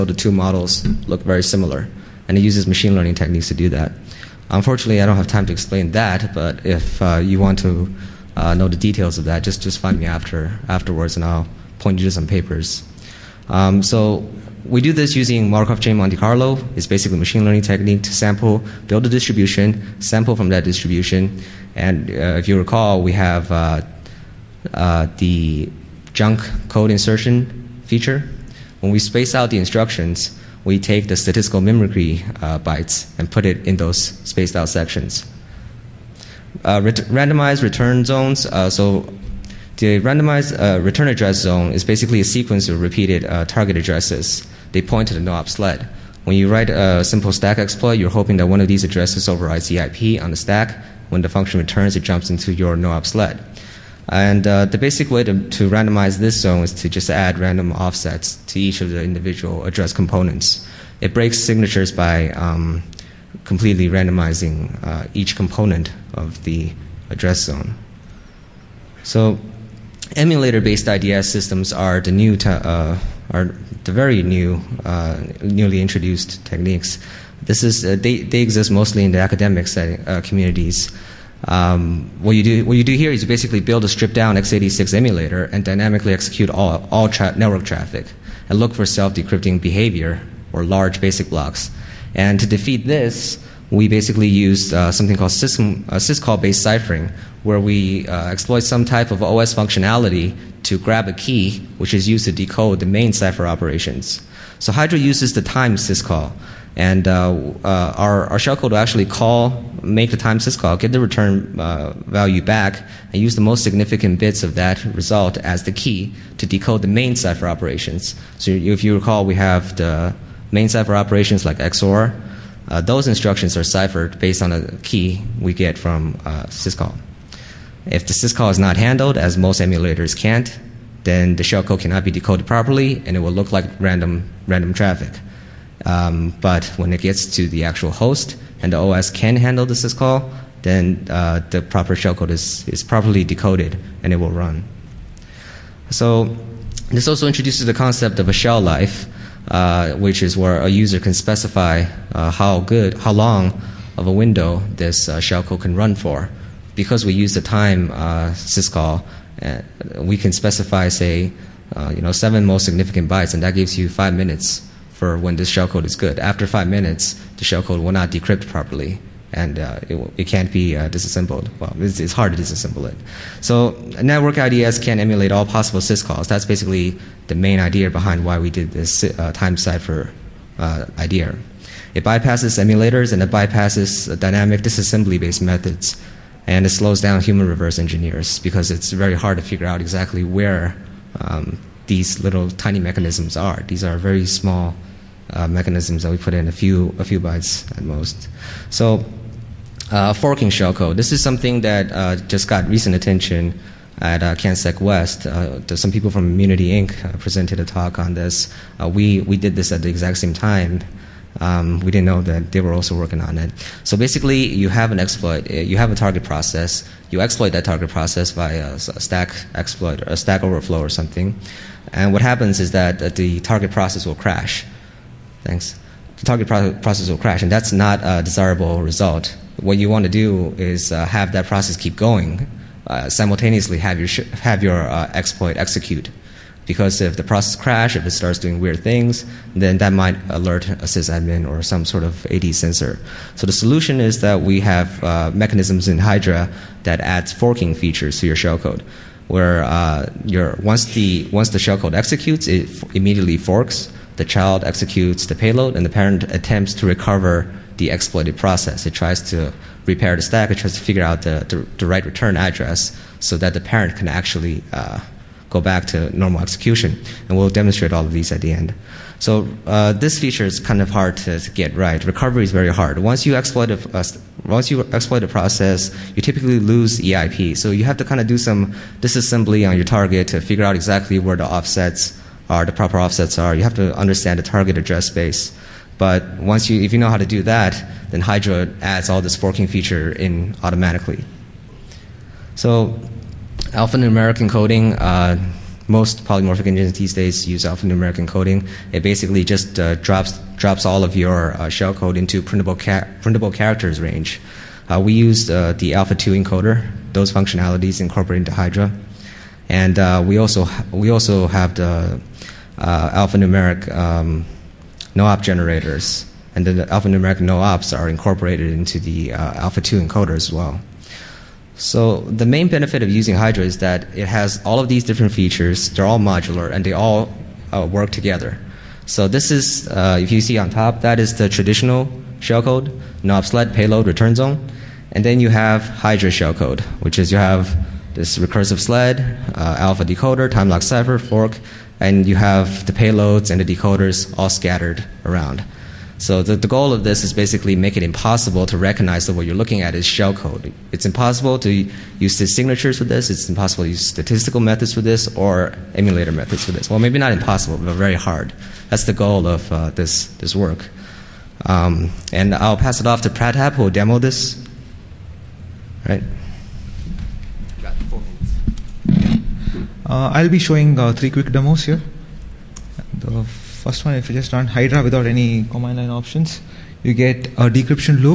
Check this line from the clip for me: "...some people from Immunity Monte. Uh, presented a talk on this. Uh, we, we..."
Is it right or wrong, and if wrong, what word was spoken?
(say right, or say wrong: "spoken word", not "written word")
wrong: "Inc", not "Monte".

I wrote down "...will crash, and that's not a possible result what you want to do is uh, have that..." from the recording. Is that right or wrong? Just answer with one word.
wrong.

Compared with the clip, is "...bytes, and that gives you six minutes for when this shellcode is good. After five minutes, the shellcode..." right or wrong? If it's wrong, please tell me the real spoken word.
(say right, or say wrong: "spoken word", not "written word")
wrong: "five", not "six".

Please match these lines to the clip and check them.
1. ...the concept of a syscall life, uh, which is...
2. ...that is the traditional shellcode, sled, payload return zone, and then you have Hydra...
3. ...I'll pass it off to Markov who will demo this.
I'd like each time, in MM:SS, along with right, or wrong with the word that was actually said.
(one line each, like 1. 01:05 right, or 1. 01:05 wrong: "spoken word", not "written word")
1. 02:27 wrong: "shell", not "syscall"
2. 05:31 right
3. 06:02 wrong: "Pratap", not "Markov".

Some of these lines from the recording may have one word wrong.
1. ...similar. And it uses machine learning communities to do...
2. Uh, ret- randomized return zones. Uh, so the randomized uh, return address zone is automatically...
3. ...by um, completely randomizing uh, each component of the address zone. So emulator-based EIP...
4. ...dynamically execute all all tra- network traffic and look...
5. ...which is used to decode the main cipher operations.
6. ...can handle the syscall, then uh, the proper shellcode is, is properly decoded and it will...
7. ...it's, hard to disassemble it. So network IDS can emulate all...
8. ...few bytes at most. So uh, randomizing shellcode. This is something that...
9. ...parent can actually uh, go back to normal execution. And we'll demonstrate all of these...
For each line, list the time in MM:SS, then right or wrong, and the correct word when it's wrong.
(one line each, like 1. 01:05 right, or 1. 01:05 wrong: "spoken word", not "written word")
1. 00:01 wrong: "techniques", not "communities"
2. 00:36 wrong: "basically", not "automatically"
3. 01:01 wrong: "IDS", not "EIP"
4. 01:25 right
5. 01:41 right
6. 02:19 right
7. 02:51 right
8. 03:17 wrong: "forking", not "randomizing"
9. 04:23 right.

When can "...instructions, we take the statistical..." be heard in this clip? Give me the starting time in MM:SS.
00:29.